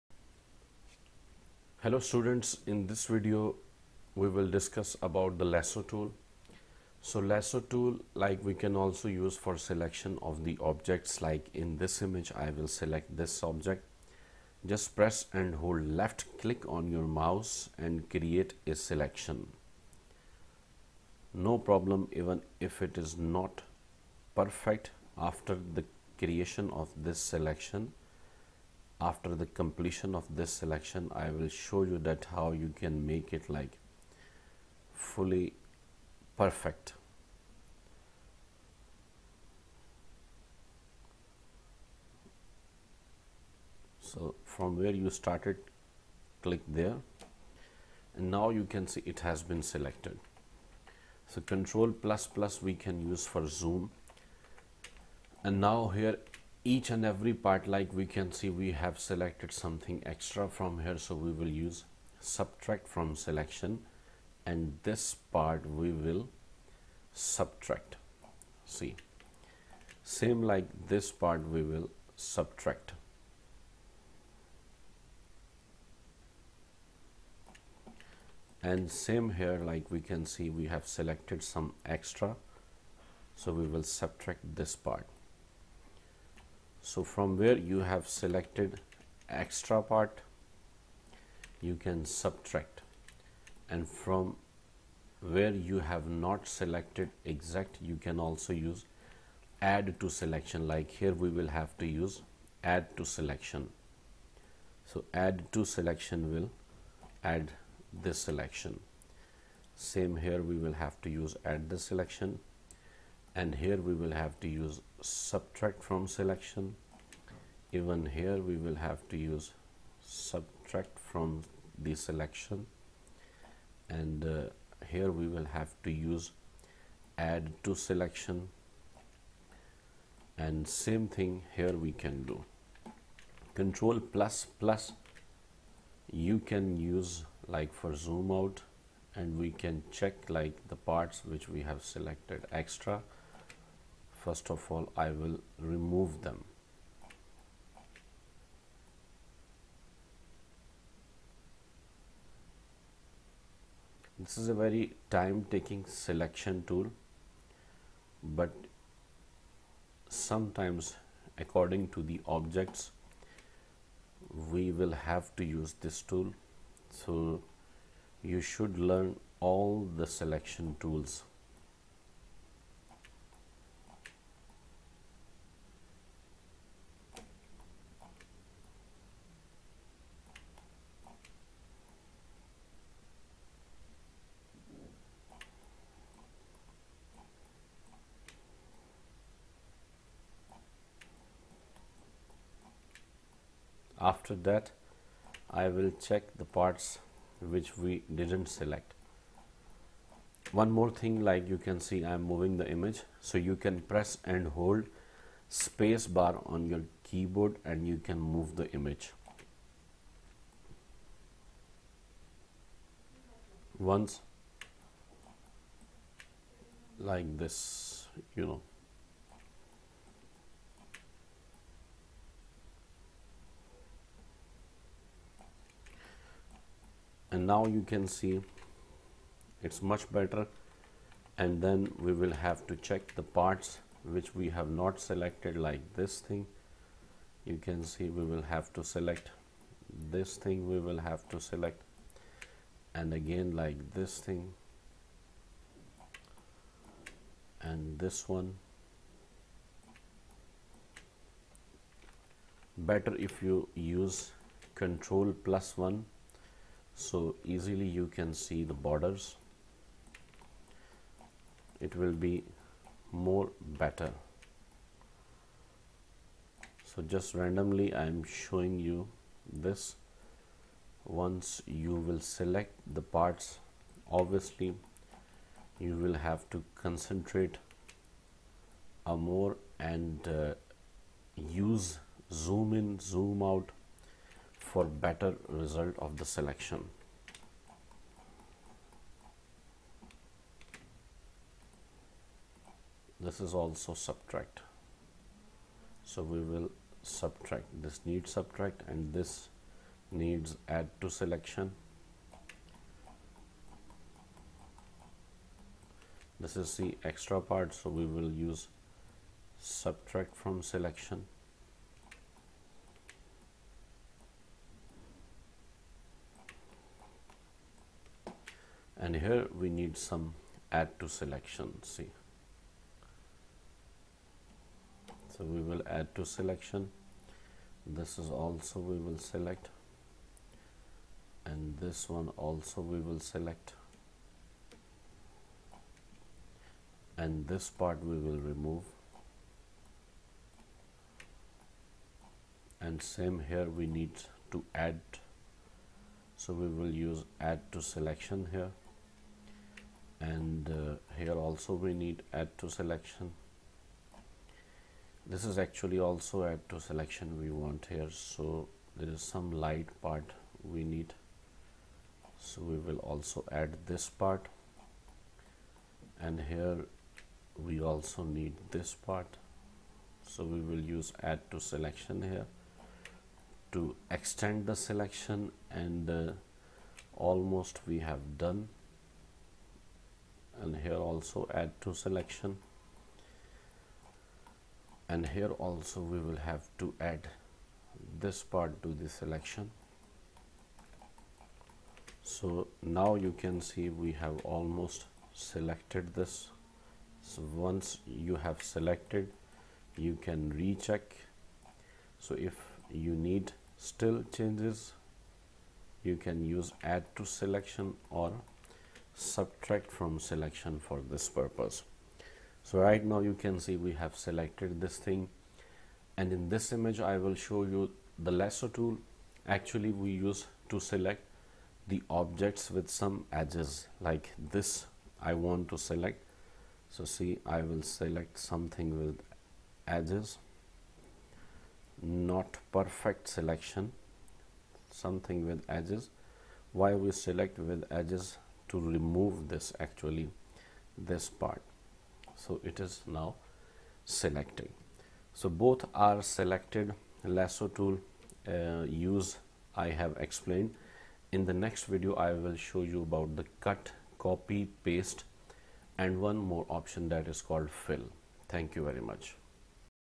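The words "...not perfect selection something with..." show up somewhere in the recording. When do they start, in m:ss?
7:12.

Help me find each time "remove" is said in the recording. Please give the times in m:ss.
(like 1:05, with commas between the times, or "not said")
2:25, 5:38, 7:18.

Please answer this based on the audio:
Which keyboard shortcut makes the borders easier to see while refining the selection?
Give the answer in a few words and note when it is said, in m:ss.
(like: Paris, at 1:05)
Control plus 1, at 4:14.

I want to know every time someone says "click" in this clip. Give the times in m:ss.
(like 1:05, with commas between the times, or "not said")
0:16, 0:46.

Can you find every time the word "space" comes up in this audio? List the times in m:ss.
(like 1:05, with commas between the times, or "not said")
3:25.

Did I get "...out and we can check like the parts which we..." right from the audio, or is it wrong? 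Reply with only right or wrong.
right.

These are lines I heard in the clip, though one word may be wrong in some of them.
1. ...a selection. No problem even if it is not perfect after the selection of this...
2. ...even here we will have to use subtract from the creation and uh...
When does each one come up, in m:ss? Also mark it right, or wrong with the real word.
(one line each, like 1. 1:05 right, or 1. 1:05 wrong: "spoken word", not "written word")
1. 0:18 wrong: "creation", not "selection"
2. 1:57 wrong: "selection", not "creation".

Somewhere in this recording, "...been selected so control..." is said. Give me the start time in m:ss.
0:49.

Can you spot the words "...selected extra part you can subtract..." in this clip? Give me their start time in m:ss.
1:28.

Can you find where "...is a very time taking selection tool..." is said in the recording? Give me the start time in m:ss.
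2:34.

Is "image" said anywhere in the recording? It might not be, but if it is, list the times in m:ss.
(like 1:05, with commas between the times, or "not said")
0:12, 3:22, 3:28, 6:56.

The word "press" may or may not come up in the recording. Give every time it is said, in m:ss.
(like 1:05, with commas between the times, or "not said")
0:14, 3:23.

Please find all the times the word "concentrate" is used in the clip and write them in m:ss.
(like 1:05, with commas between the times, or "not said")
4:36.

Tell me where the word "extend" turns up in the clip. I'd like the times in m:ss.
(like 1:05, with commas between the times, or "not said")
6:14.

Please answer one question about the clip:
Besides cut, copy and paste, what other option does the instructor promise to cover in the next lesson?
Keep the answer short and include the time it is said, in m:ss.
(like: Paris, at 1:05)
Fill, at 7:37.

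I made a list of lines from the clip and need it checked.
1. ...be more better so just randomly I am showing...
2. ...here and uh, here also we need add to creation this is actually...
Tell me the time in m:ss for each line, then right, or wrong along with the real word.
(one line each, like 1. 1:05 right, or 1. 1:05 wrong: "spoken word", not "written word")
1. 4:22 right
2. 5:48 wrong: "selection", not "creation".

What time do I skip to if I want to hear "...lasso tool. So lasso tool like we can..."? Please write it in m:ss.
0:05.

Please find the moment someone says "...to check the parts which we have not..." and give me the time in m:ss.
3:52.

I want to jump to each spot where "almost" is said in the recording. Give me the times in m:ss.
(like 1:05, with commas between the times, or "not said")
6:17, 6:34.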